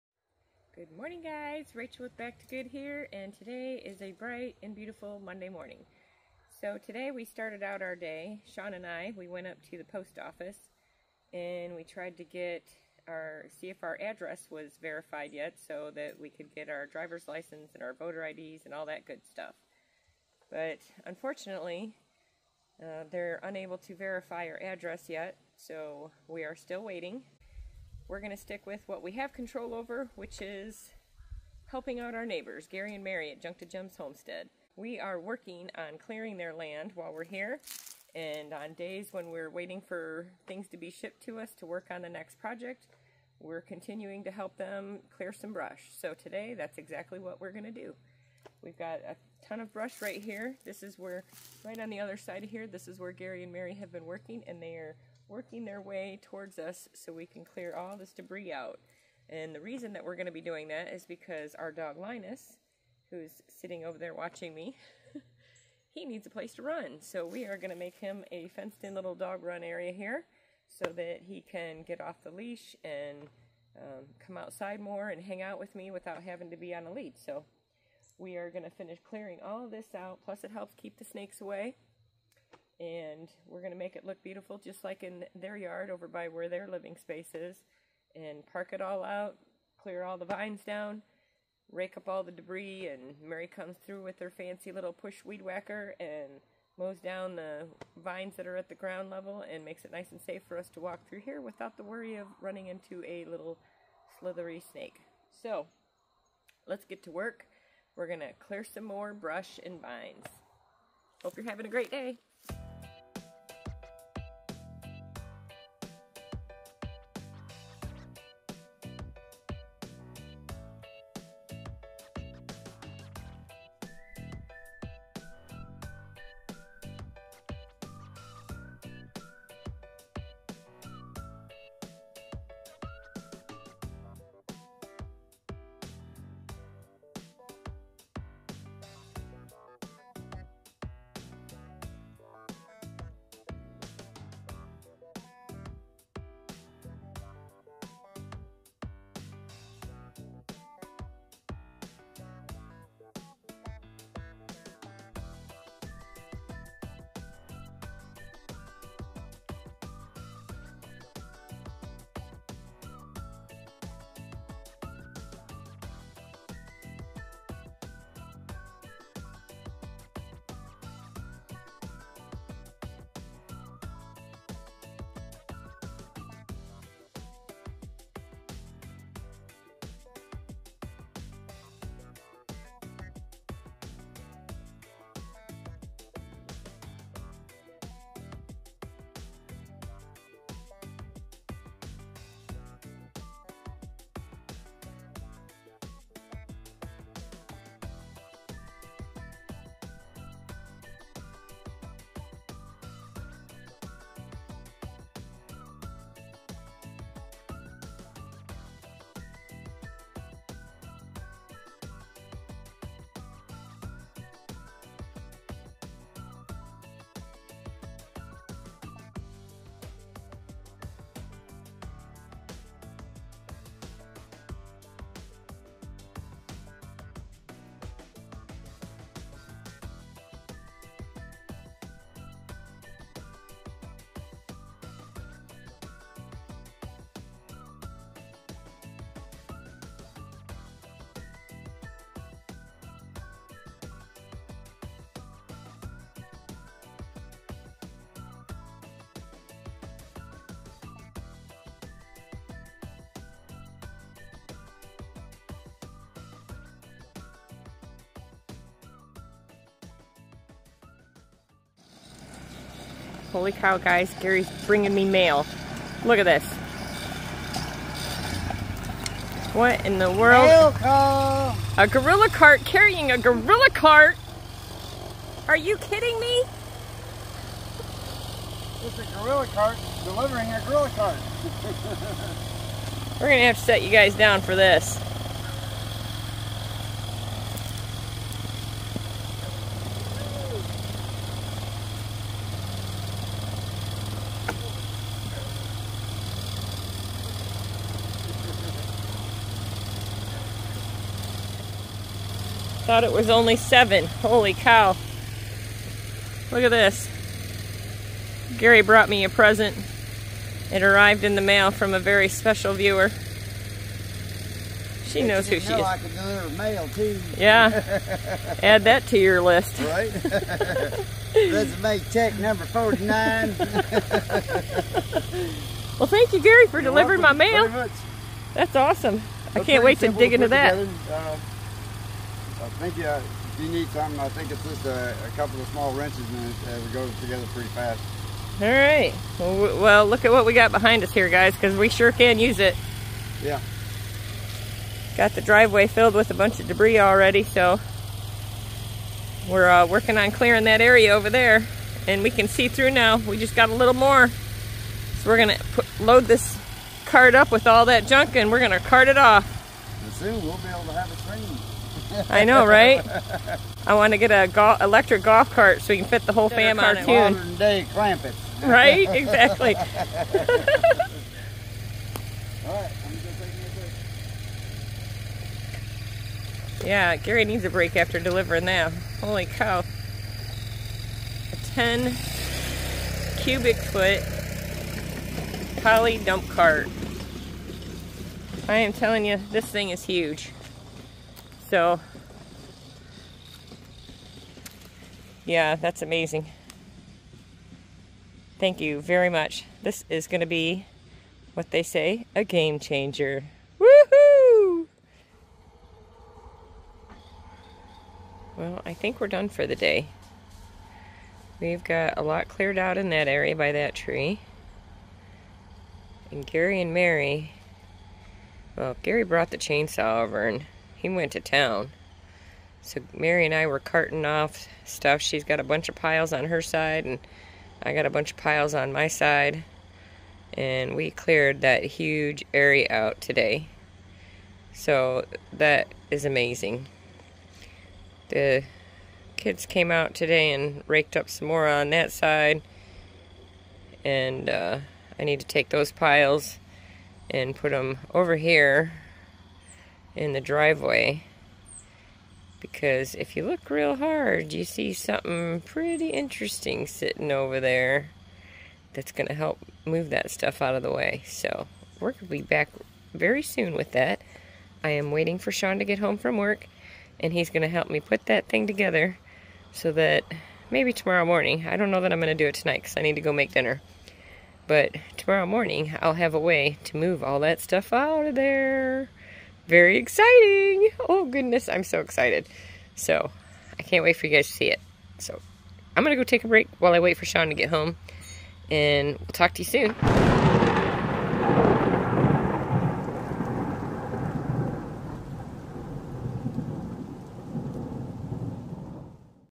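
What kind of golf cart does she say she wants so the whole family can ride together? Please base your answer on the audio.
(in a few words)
electric.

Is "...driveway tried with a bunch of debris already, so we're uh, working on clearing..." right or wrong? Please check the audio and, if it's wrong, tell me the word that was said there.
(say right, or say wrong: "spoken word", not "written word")
wrong: "filled", not "tried".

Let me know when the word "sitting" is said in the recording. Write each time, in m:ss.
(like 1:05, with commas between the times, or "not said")
1:03, 7:36.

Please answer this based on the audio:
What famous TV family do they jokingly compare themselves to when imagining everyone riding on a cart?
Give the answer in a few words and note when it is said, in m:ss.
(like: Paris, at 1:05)
Clampetts, at 6:07.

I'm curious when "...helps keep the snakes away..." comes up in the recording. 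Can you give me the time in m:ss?
1:20.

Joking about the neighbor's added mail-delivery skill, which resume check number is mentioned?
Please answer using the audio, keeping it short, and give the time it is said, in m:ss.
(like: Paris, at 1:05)
49, at 5:22.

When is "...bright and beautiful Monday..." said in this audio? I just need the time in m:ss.
0:04.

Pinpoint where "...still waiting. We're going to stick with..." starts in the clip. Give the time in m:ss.
0:26.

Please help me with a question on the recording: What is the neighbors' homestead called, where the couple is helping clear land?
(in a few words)
to Gems Homestead.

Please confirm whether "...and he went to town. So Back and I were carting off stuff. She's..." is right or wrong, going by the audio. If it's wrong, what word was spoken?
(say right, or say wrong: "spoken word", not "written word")
wrong: "Mary", not "Back".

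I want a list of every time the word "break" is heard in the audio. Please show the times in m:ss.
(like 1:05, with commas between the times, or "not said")
6:17, 8:06.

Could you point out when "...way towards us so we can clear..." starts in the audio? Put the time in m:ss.
0:55.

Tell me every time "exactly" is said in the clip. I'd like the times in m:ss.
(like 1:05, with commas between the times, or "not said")
0:46, 6:09.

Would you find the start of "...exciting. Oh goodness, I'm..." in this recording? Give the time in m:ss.
7:59.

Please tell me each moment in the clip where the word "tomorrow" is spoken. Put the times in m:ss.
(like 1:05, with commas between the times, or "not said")
7:50, 7:55.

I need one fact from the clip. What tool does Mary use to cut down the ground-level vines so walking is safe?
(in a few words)
push weed whacker.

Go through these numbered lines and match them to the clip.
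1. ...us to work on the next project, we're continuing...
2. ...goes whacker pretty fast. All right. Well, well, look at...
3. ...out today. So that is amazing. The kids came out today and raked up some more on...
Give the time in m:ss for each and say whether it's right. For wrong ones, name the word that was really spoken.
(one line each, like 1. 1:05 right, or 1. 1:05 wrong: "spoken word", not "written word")
1. 0:41 right
2. 5:36 wrong: "together", not "whacker"
3. 7:12 right.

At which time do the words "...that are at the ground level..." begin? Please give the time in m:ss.
1:38.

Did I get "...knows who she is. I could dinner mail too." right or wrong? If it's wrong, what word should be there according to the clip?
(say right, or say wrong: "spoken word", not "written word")
wrong: "deliver", not "dinner".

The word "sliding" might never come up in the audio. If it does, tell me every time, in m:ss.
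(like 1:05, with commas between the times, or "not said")
not said.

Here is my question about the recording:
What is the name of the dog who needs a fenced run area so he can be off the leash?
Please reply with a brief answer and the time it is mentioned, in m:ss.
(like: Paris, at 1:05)
Linus, at 1:01.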